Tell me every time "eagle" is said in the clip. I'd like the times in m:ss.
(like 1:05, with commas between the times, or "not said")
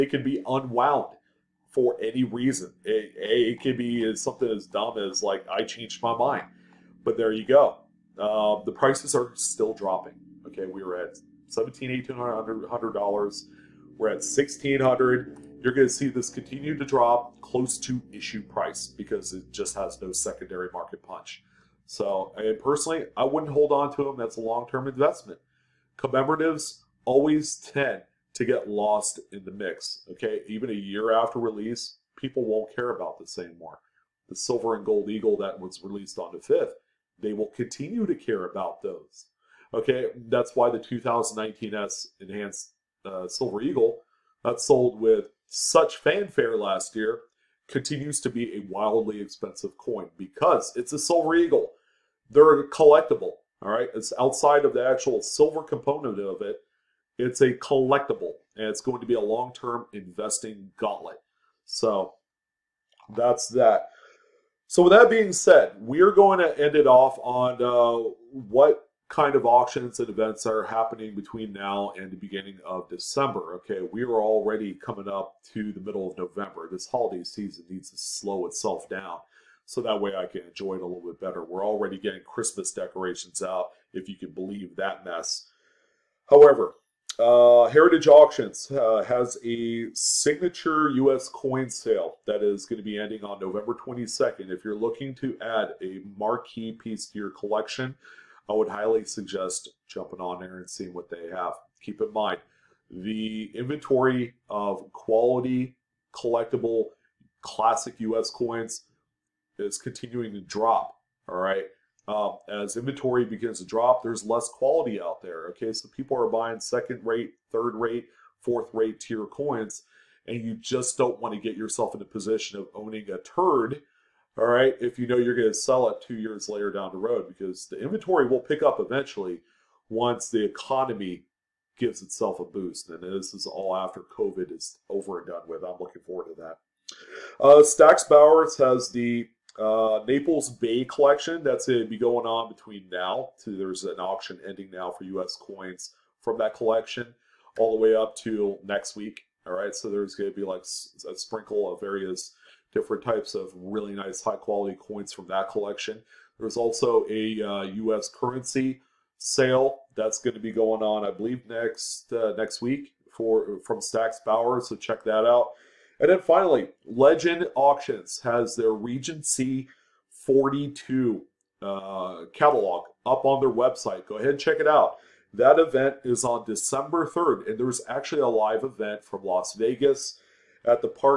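0:35, 0:43, 0:51.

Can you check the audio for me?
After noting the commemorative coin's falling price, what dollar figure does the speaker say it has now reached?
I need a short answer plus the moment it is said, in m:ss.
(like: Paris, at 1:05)
1600, at 0:14.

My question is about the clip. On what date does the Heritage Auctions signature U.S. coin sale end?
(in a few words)
November 22.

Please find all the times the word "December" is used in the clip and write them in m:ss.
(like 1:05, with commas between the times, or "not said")
1:12, 2:56.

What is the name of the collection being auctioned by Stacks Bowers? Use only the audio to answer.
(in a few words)
Naples Bay collection.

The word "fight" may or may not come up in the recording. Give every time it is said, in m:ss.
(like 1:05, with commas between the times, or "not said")
not said.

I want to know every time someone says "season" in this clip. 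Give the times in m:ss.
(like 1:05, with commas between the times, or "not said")
1:17.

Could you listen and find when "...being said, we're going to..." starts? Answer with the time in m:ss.
1:05.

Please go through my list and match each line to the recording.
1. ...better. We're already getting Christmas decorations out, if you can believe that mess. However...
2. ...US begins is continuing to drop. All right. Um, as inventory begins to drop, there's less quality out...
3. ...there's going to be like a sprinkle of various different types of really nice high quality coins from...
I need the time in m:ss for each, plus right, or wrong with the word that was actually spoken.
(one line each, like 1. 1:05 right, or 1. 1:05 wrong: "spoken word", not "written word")
1. 1:21 right
2. 1:47 wrong: "coins", not "begins"
3. 2:29 right.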